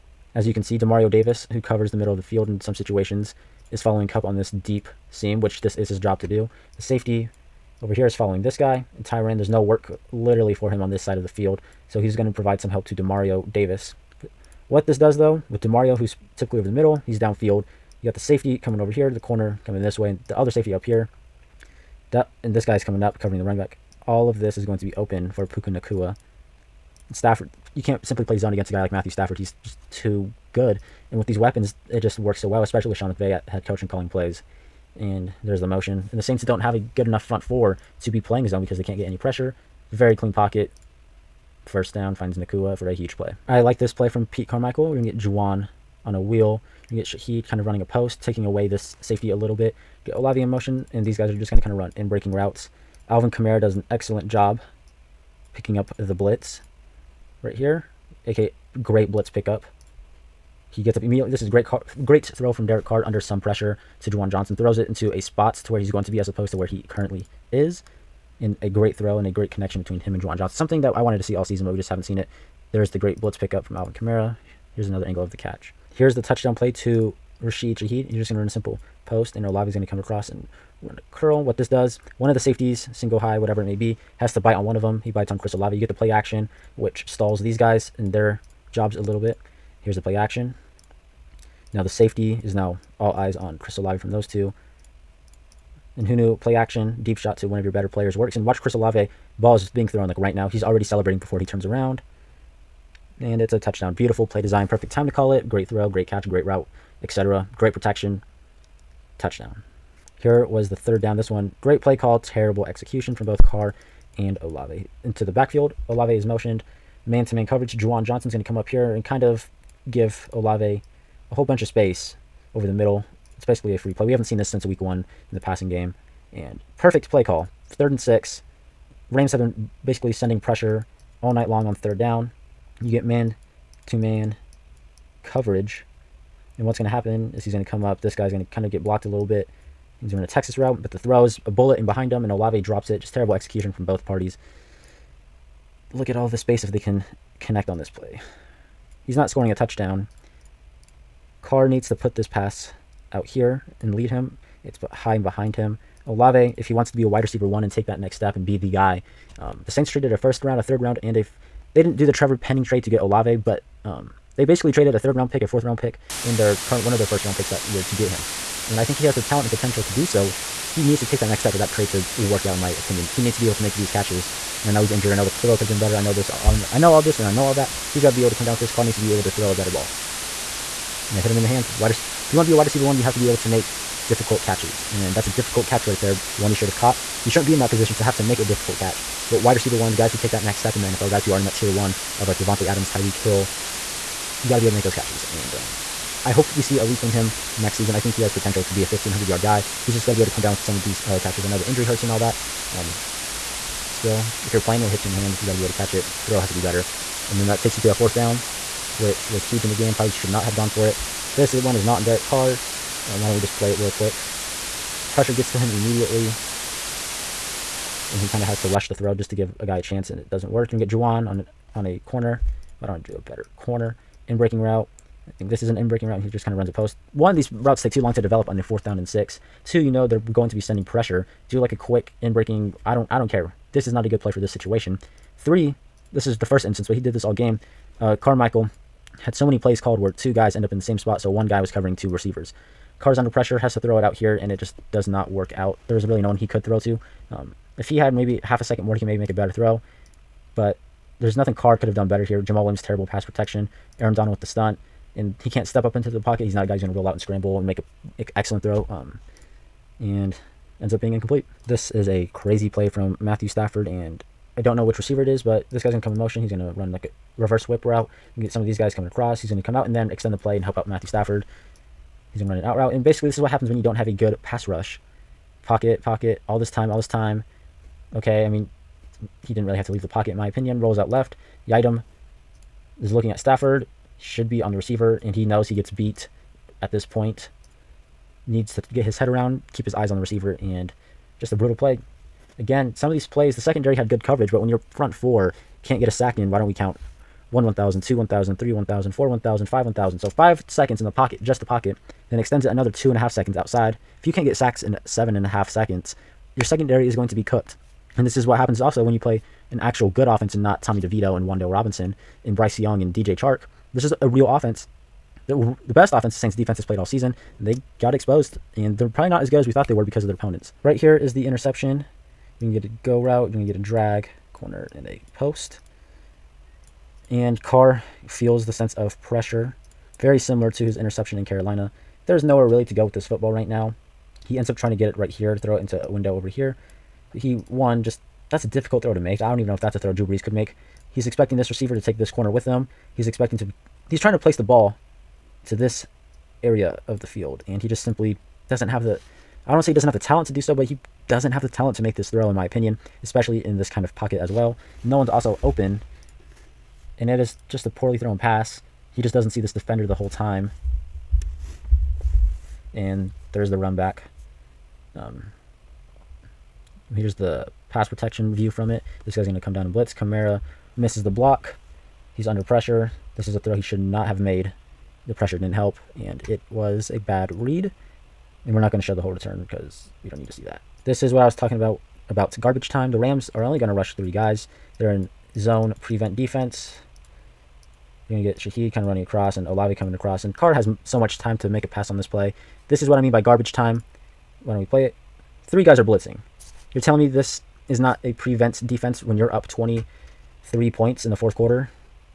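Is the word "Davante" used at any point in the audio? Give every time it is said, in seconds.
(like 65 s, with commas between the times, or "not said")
192 s.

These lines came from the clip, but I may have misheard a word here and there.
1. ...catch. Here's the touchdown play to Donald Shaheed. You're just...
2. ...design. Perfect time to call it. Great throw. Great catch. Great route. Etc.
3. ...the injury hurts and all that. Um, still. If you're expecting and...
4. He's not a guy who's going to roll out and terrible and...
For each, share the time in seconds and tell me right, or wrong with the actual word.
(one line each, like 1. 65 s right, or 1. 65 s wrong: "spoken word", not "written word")
1. 75 s wrong: "Rashid", not "Donald"
2. 104 s right
3. 201 s wrong: "playing", not "expecting"
4. 256 s wrong: "scramble", not "terrible".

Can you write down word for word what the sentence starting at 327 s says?
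And Carr feels the sense of pressure, very similar to his interception in Carolina.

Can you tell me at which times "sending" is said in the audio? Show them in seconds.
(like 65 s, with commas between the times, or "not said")
130 s, 230 s.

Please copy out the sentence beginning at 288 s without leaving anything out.
Needs to get his head around, keep his eyes on the receiver, and just a brutal play.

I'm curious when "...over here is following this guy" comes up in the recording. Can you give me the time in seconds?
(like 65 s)
7 s.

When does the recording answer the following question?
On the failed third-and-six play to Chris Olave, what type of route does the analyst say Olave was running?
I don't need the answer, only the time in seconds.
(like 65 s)
140 s.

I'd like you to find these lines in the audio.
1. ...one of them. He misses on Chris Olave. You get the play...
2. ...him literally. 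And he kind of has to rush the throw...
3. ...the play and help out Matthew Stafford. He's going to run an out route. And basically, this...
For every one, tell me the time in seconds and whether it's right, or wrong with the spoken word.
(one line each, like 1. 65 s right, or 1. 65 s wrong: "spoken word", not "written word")
1. 84 s wrong: "bites", not "misses"
2. 215 s wrong: "immediately", not "literally"
3. 270 s right.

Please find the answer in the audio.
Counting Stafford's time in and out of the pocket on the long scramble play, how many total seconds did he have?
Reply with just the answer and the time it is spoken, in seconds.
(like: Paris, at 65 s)
7.5, at 305 s.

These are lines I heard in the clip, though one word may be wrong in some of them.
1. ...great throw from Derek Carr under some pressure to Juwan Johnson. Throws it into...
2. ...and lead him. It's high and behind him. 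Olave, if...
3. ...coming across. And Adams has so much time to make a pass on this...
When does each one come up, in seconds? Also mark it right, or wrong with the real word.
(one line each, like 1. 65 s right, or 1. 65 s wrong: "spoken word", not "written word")
1. 62 s right
2. 153 s right
3. 389 s wrong: "Carr", not "Adams".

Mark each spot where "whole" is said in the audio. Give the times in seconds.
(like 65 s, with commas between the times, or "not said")
121 s, 360 s, 379 s.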